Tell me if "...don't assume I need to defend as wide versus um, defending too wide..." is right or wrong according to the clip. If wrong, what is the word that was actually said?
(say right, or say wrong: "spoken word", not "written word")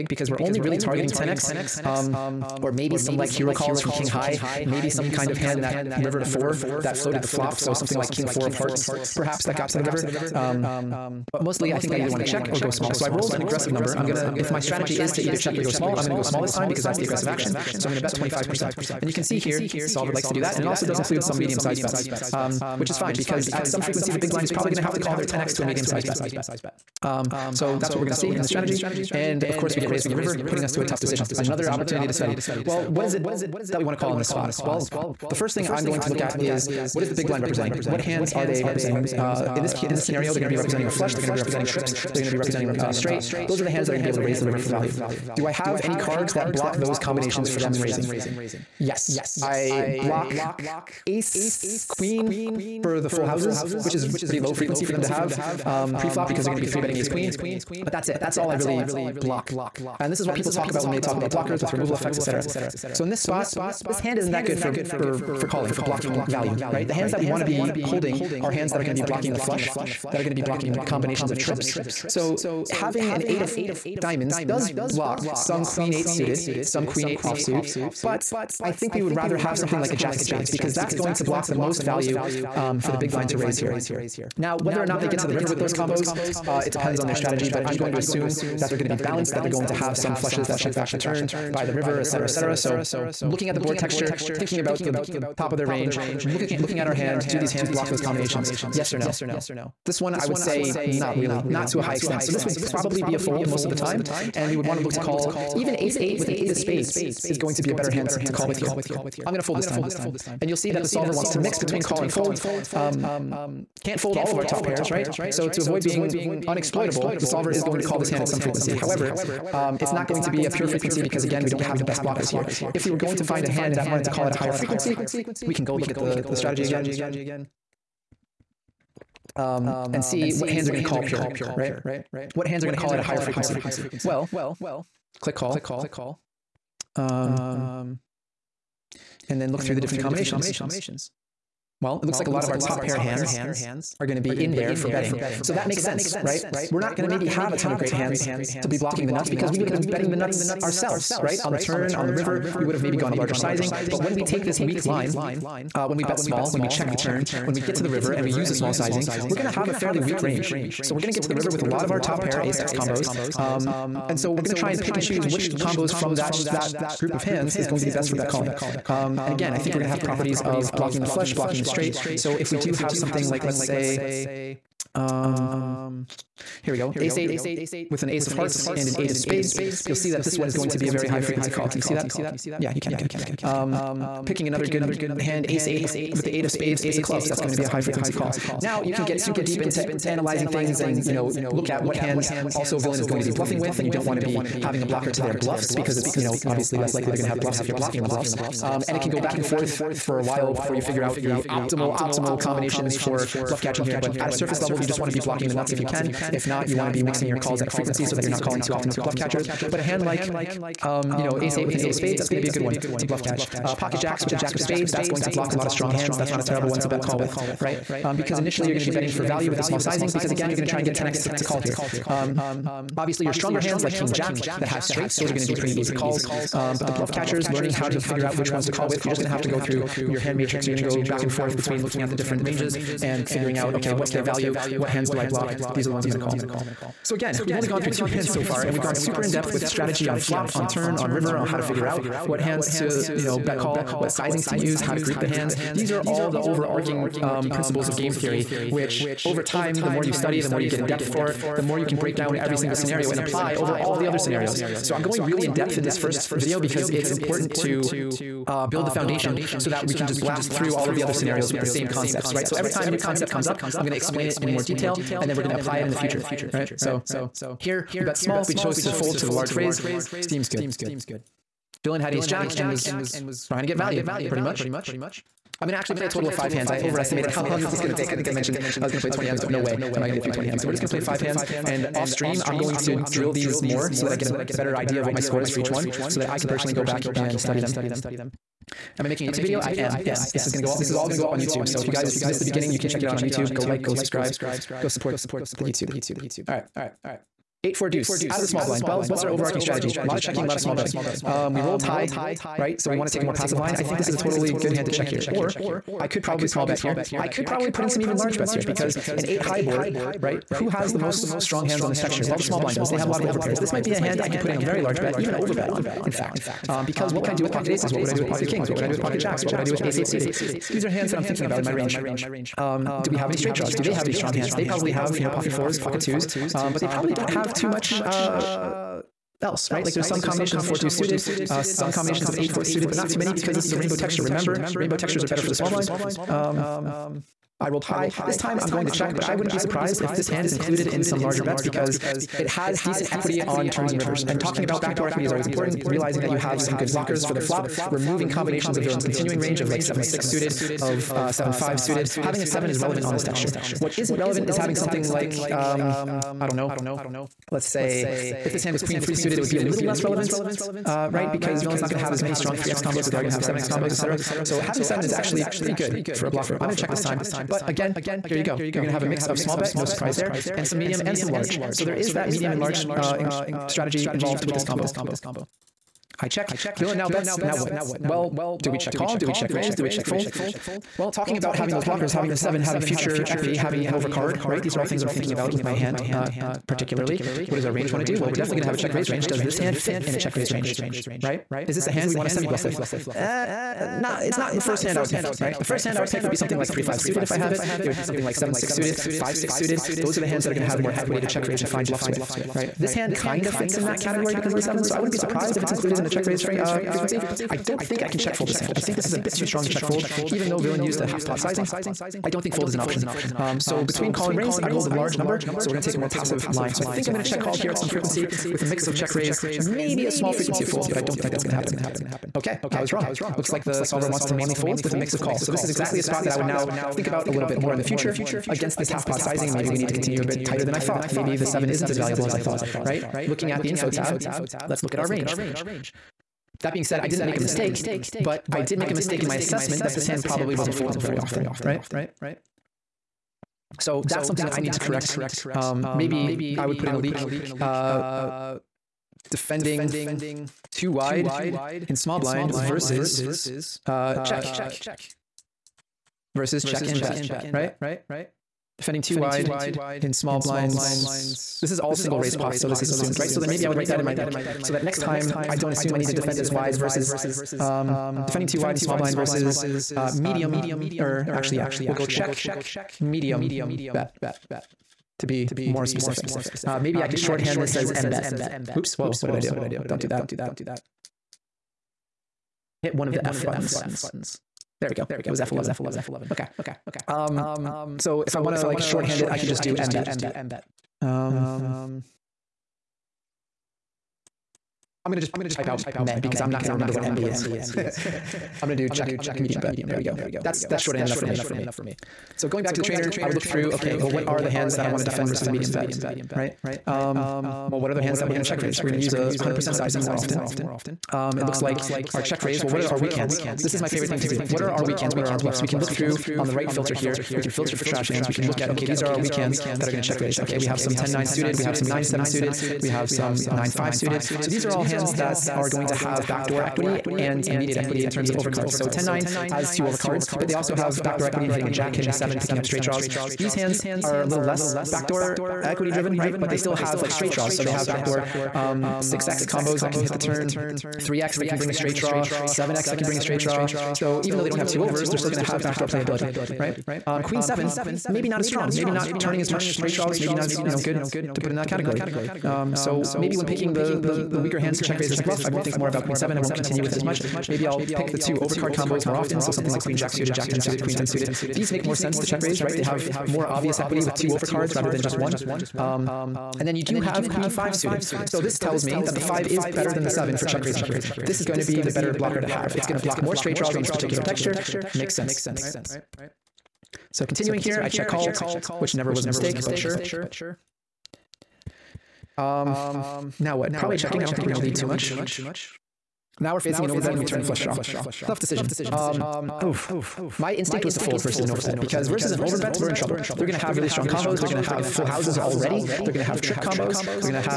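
right.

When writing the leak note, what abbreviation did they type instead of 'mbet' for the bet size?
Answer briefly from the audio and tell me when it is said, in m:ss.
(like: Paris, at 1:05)
med, at 8:15.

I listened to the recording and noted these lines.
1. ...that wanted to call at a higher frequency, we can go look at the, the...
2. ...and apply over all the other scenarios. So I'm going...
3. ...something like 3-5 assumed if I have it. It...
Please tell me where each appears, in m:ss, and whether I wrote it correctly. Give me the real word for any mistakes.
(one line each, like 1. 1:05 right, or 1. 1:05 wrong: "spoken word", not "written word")
1. 2:03 right
2. 4:13 right
3. 6:36 wrong: "suited", not "assumed".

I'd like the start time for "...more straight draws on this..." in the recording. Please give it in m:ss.
9:33.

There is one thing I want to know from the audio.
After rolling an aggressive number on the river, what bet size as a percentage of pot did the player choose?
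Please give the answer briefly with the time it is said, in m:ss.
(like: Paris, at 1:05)
25%, at 0:18.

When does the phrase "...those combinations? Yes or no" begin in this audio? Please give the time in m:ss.
1:37.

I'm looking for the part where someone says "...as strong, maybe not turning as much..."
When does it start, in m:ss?
9:08.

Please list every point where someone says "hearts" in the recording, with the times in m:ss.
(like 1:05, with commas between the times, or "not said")
0:08, 2:58.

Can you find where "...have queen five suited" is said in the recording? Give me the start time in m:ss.
9:27.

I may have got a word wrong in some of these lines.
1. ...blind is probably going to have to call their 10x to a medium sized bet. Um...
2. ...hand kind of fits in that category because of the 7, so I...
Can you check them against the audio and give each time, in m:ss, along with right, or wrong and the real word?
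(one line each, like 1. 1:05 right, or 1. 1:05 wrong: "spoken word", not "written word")
1. 0:24 right
2. 6:42 right.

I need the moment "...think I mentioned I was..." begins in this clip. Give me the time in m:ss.
4:38.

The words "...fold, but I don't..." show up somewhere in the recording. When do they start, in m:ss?
7:00.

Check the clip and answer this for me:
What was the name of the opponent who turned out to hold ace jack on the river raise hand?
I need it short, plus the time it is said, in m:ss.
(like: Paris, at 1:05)
Dylan, at 4:31.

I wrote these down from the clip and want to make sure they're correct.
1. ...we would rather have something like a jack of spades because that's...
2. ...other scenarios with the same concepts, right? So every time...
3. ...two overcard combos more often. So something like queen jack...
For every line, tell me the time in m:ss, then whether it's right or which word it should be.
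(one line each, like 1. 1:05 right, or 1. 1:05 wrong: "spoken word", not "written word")
1. 1:18 right
2. 4:21 right
3. 9:18 right.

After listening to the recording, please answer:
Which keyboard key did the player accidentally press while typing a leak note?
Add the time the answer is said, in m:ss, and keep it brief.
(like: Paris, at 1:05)
F11, at 8:05.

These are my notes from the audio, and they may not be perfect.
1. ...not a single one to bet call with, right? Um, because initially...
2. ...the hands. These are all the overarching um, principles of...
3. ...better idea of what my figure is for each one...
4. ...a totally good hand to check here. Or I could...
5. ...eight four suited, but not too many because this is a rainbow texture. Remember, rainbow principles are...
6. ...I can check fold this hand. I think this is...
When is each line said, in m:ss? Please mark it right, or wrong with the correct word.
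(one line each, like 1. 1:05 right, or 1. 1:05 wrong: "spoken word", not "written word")
1. 3:36 wrong: "terrible", not "single"
2. 4:05 right
3. 4:44 wrong: "score", not "figure"
4. 5:04 right
5. 5:32 wrong: "textures", not "principles"
6. 6:48 right.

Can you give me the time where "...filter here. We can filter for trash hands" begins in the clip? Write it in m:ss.
8:36.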